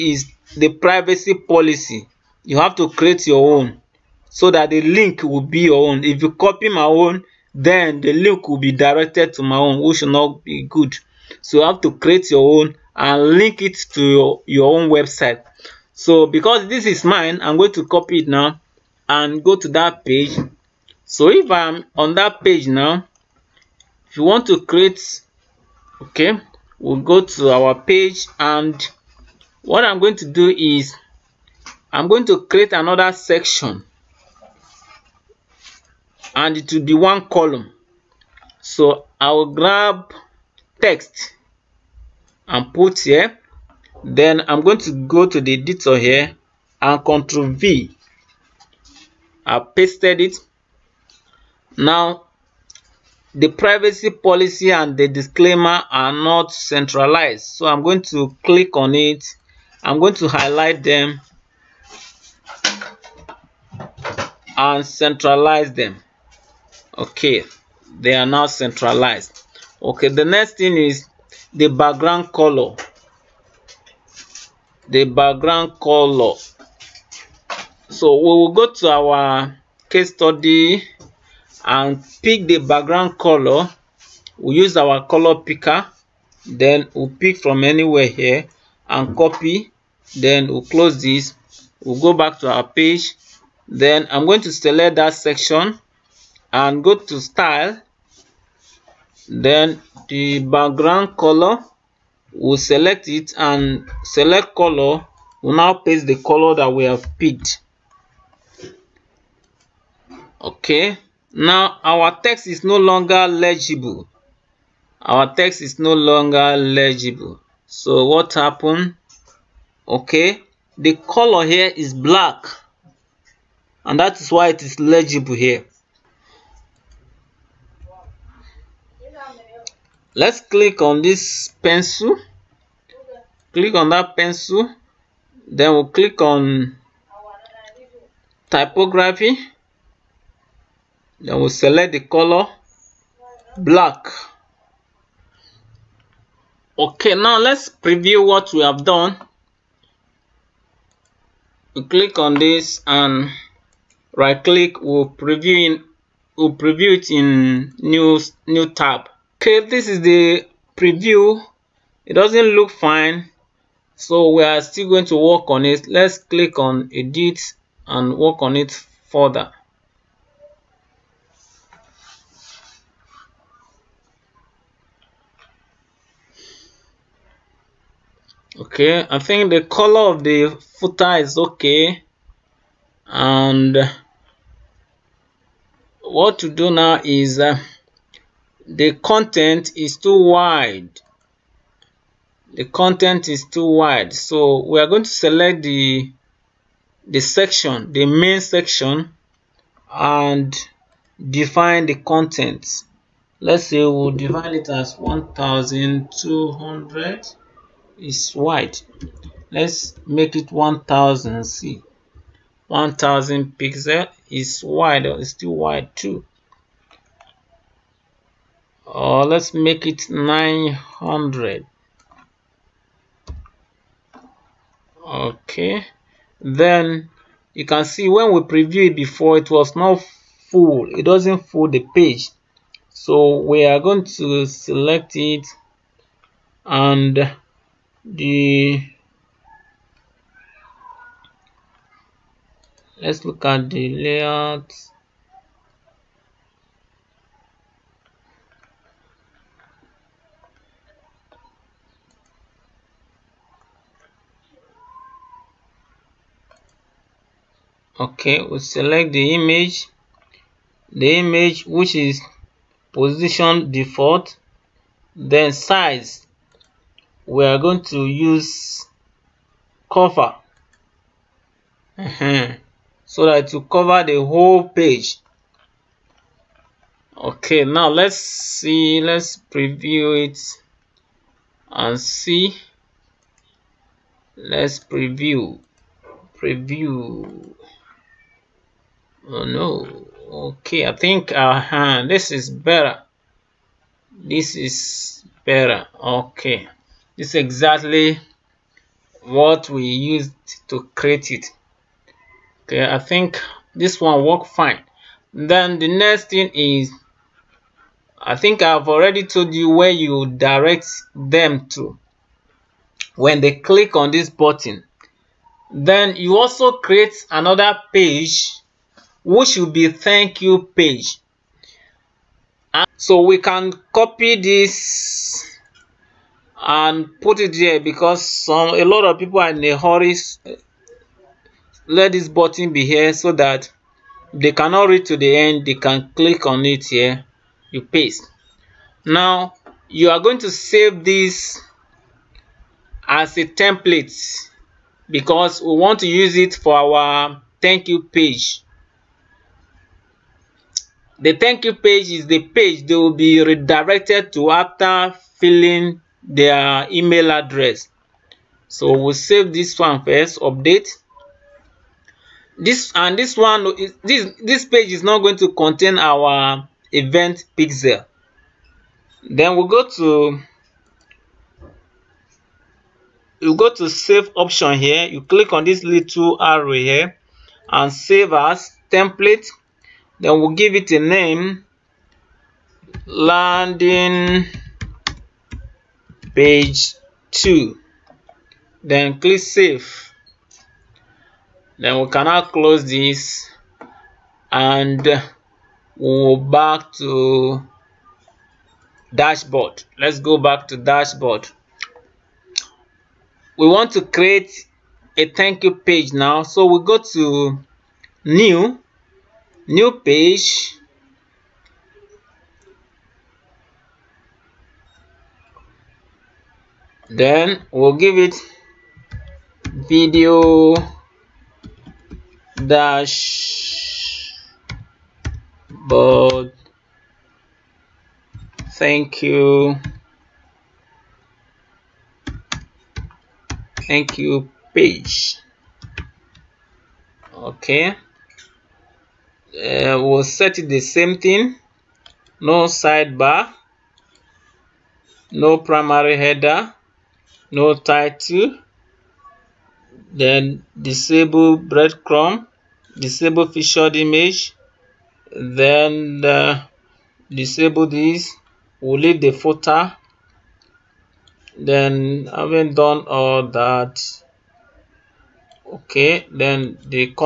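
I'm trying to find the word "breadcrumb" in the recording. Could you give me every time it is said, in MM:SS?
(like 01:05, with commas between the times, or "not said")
07:31.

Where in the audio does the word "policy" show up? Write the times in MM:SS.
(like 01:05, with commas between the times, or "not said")
00:01, 00:54.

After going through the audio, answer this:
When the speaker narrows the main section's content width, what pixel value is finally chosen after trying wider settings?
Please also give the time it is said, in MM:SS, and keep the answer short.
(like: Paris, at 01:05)
900, at 03:40.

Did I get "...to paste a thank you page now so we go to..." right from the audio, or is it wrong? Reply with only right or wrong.
wrong.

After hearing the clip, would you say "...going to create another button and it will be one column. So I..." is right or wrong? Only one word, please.
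wrong.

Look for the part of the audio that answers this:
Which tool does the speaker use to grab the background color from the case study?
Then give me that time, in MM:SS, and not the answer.
01:25.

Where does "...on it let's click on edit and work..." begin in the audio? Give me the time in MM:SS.
02:45.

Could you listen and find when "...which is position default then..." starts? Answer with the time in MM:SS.
04:21.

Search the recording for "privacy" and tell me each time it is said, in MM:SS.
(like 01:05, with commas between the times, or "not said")
00:00, 00:53.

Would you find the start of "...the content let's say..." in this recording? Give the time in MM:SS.
03:21.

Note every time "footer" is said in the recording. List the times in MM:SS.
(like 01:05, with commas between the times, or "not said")
03:00, 07:39.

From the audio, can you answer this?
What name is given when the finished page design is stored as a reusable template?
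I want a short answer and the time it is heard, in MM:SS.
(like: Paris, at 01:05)
landing page 2, at 06:23.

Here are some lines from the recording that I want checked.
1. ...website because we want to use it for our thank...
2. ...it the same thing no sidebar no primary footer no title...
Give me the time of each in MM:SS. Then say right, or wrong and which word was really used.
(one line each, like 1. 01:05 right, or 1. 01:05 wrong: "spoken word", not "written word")
1. 05:43 wrong: "template", not "website"
2. 07:20 wrong: "header", not "footer".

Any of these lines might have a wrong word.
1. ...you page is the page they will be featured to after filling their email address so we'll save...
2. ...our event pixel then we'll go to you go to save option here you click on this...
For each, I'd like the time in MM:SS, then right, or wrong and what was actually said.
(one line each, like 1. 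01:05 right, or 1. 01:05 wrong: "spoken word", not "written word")
1. 05:51 wrong: "redirected", not "featured"
2. 06:05 right.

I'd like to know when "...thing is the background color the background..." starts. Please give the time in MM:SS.
01:10.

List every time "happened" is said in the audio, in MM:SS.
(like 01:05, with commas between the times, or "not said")
01:58.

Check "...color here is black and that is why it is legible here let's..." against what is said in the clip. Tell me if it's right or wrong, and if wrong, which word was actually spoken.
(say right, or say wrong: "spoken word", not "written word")
right.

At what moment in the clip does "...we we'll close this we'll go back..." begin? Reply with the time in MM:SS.
01:30.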